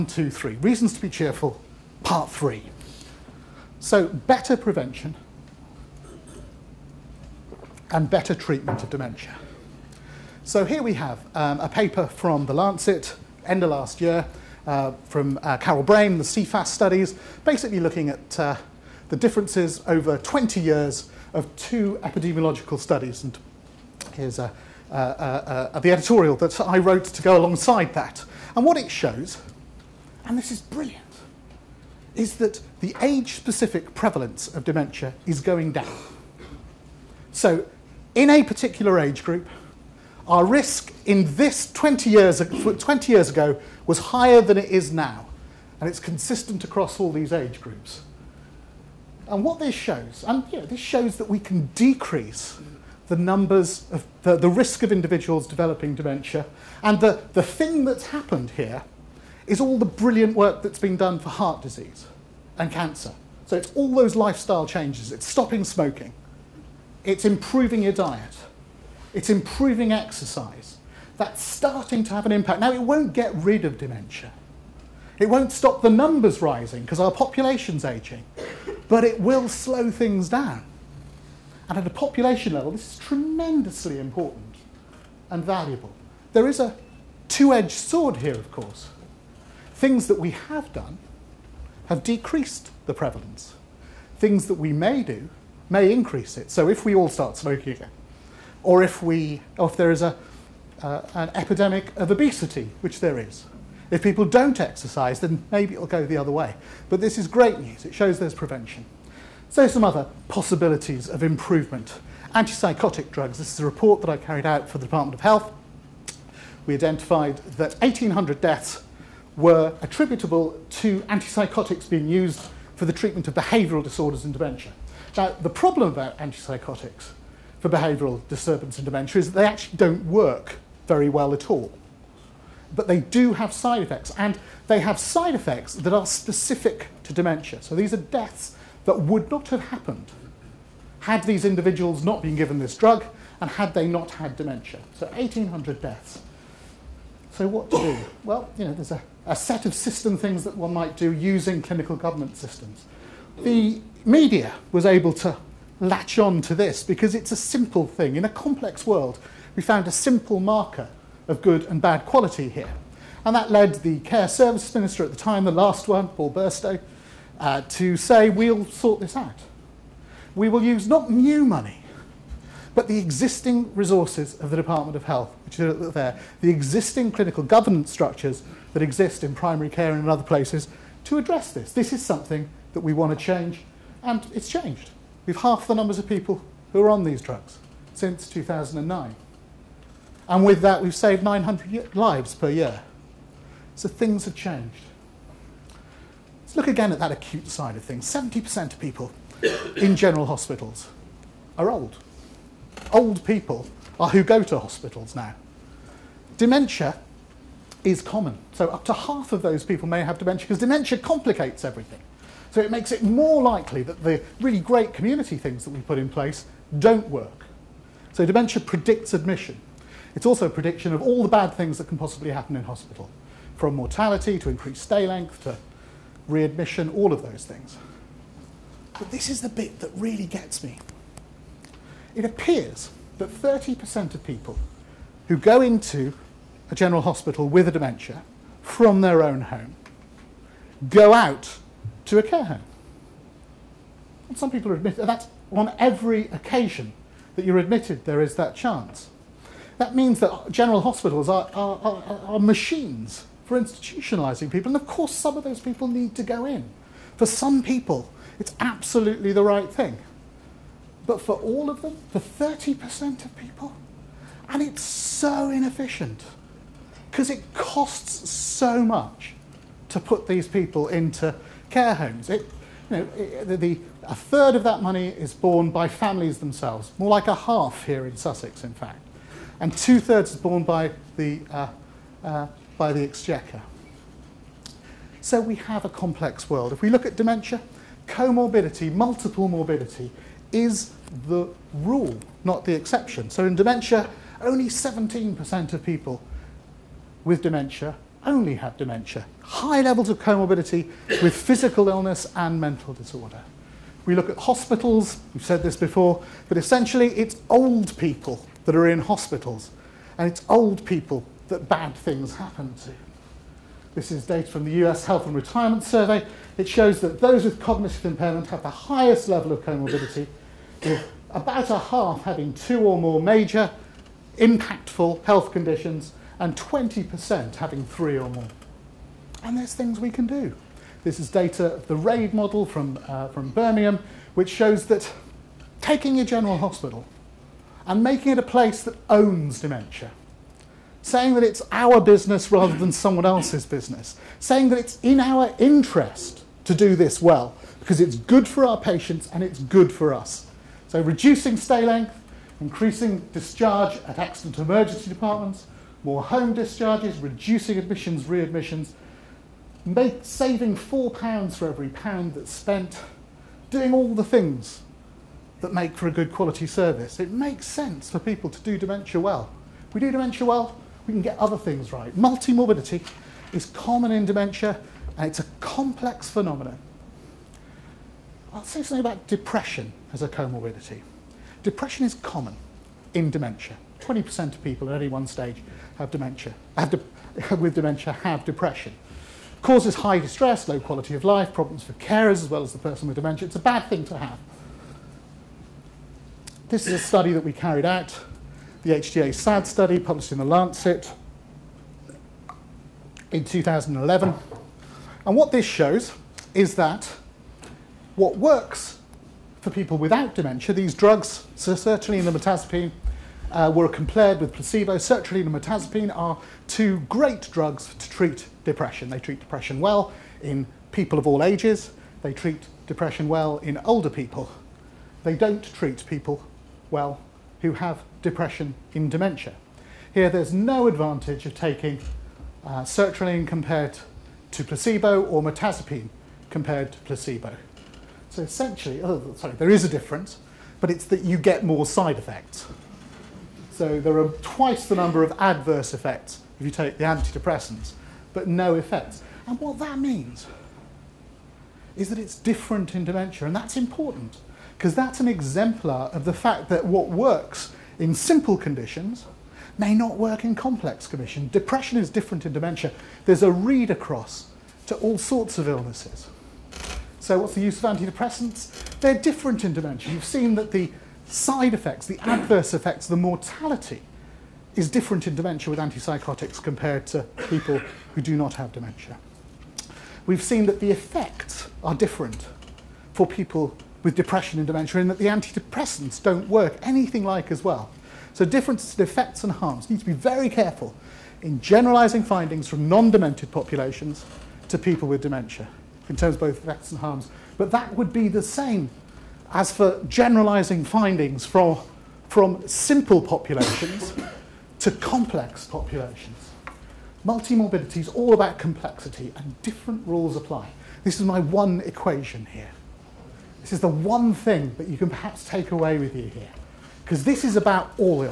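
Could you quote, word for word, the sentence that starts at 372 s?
Multimorbidity is common in dementia and it's a complex phenomenon.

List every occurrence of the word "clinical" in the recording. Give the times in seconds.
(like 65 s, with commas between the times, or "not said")
151 s, 177 s.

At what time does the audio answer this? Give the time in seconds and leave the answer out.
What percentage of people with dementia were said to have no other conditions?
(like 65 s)
294 s.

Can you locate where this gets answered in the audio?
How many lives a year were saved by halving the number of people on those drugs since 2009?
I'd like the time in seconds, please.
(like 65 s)
191 s.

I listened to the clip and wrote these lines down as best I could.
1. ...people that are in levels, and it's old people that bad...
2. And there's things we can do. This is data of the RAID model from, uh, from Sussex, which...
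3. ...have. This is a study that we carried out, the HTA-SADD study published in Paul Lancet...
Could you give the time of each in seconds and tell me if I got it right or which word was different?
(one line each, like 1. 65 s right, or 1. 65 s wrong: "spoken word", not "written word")
1. 307 s wrong: "hospitals", not "levels"
2. 329 s wrong: "Birmingham", not "Sussex"
3. 394 s wrong: "The", not "Paul".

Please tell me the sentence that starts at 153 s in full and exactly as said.
The media was able to latch on to this because it's a simple thing.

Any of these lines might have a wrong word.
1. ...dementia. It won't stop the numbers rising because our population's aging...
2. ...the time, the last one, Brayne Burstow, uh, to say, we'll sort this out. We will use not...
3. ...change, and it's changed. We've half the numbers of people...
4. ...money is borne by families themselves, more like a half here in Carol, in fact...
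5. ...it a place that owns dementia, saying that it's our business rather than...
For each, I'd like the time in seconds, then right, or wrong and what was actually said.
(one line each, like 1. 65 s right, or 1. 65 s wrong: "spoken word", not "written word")
1. 73 s right
2. 165 s wrong: "Paul", not "Brayne"
3. 183 s right
4. 274 s wrong: "Sussex", not "Carol"
5. 338 s right.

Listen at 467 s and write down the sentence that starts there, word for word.
So what's the use of antidepressants?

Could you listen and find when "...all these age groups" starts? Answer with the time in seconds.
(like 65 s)
46 s.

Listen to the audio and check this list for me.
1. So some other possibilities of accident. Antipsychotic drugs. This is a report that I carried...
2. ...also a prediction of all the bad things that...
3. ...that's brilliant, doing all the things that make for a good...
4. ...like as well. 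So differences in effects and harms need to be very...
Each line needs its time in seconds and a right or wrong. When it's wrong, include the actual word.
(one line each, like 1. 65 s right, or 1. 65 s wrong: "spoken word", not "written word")
1. 109 s wrong: "improvement", not "accident"
2. 220 s right
3. 362 s wrong: "spent", not "brilliant"
4. 487 s right.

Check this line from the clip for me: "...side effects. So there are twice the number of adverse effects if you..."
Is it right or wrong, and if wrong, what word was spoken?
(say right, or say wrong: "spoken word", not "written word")
right.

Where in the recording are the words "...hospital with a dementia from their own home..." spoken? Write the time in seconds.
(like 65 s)
237 s.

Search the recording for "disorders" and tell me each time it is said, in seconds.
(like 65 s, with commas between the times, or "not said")
123 s, 302 s.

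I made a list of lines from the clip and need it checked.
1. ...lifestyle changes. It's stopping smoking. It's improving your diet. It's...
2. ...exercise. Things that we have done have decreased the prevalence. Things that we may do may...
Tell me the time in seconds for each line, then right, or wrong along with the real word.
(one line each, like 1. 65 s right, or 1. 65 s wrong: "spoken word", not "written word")
1. 64 s right
2. 88 s wrong: "course", not "exercise".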